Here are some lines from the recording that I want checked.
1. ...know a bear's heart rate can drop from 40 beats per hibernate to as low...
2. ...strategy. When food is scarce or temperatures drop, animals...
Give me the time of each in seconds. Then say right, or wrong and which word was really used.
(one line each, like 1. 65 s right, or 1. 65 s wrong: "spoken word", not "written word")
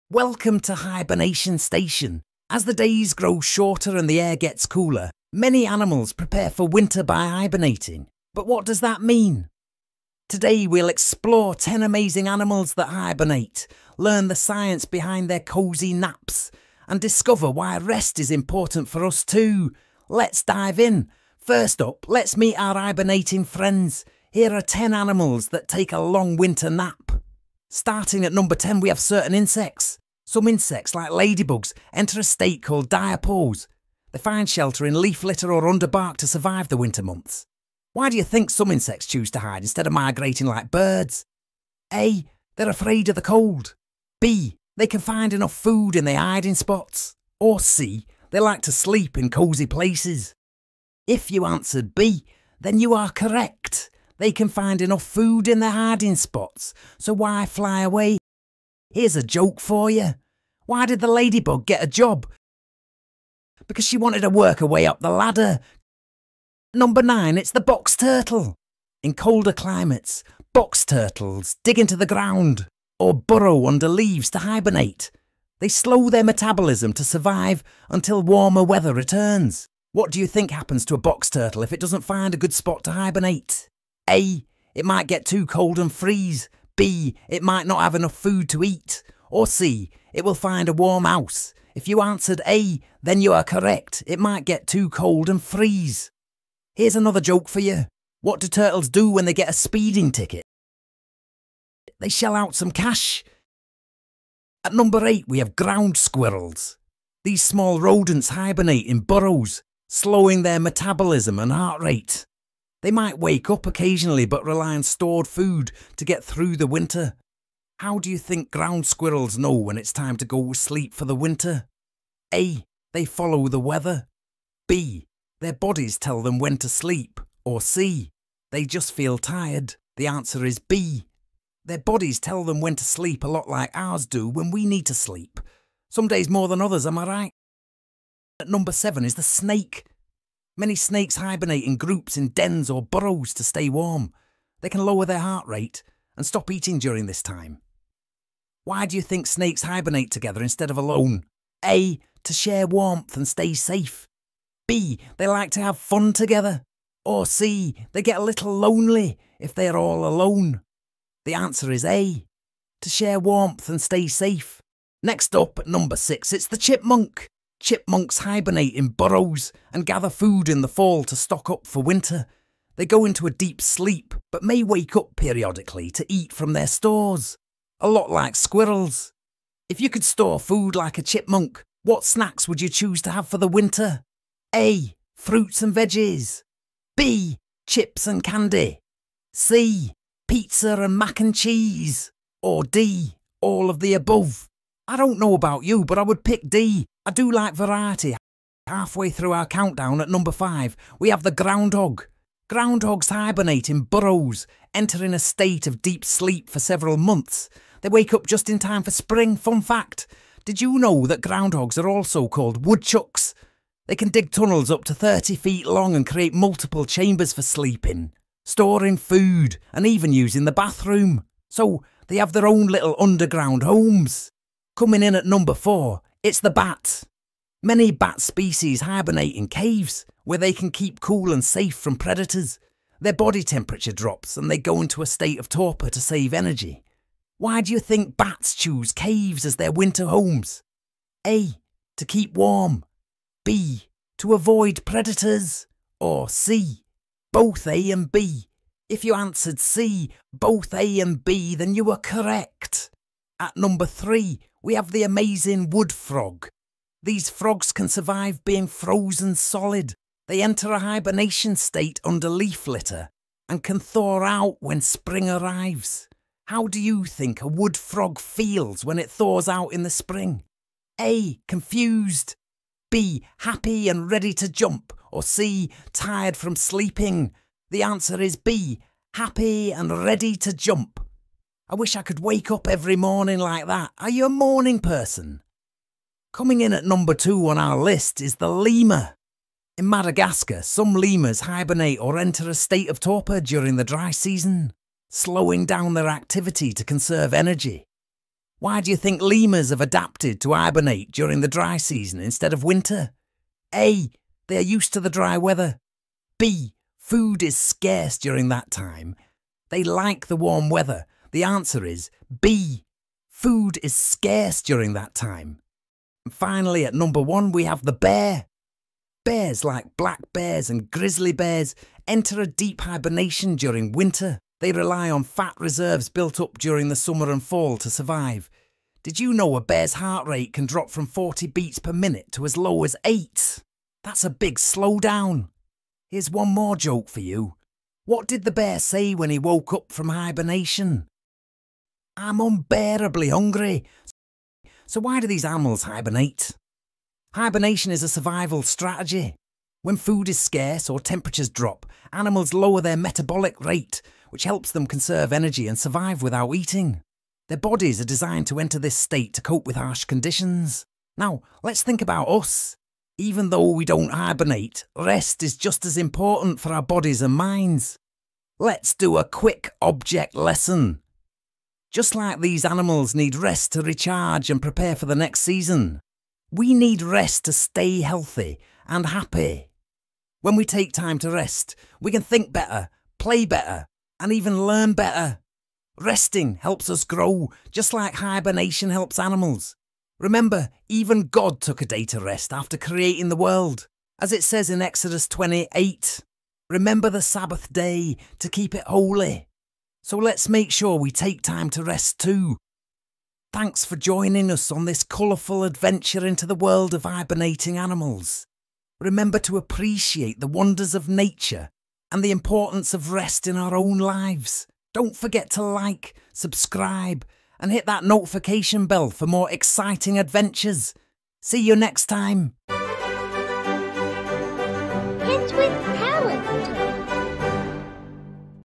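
1. 329 s wrong: "minute", not "hibernate"
2. 348 s right.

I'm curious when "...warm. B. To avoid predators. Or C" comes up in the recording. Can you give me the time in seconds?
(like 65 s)
242 s.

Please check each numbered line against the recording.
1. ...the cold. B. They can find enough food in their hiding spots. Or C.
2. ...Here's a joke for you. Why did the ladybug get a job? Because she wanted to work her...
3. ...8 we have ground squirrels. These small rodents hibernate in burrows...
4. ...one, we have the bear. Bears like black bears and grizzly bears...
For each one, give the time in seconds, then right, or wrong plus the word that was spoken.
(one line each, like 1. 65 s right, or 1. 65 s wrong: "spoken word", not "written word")
1. 43 s right
2. 58 s right
3. 105 s right
4. 317 s right.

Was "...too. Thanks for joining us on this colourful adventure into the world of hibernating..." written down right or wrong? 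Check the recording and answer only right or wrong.
right.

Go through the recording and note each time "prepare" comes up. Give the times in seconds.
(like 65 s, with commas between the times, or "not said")
6 s, 374 s.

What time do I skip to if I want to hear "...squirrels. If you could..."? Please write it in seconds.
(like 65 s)
178 s.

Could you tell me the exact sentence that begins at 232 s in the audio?
Their body temperature drops and they go into a state of torpor to save energy.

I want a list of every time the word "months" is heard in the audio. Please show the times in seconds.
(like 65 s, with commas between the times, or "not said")
37 s, 206 s.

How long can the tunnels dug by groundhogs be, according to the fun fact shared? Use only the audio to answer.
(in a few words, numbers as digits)
30 feet.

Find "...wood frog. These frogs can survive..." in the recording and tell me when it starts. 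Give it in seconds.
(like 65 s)
255 s.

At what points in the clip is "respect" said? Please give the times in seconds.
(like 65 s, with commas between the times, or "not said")
not said.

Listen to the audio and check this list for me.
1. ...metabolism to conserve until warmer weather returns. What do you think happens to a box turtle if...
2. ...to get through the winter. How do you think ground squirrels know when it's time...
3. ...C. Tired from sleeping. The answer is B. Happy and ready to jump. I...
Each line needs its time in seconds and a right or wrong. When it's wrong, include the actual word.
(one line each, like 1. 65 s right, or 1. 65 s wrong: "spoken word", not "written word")
1. 76 s wrong: "survive", not "conserve"
2. 115 s right
3. 275 s right.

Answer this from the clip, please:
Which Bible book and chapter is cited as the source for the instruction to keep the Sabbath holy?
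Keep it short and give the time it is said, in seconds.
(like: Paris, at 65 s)
Exodus 28, at 394 s.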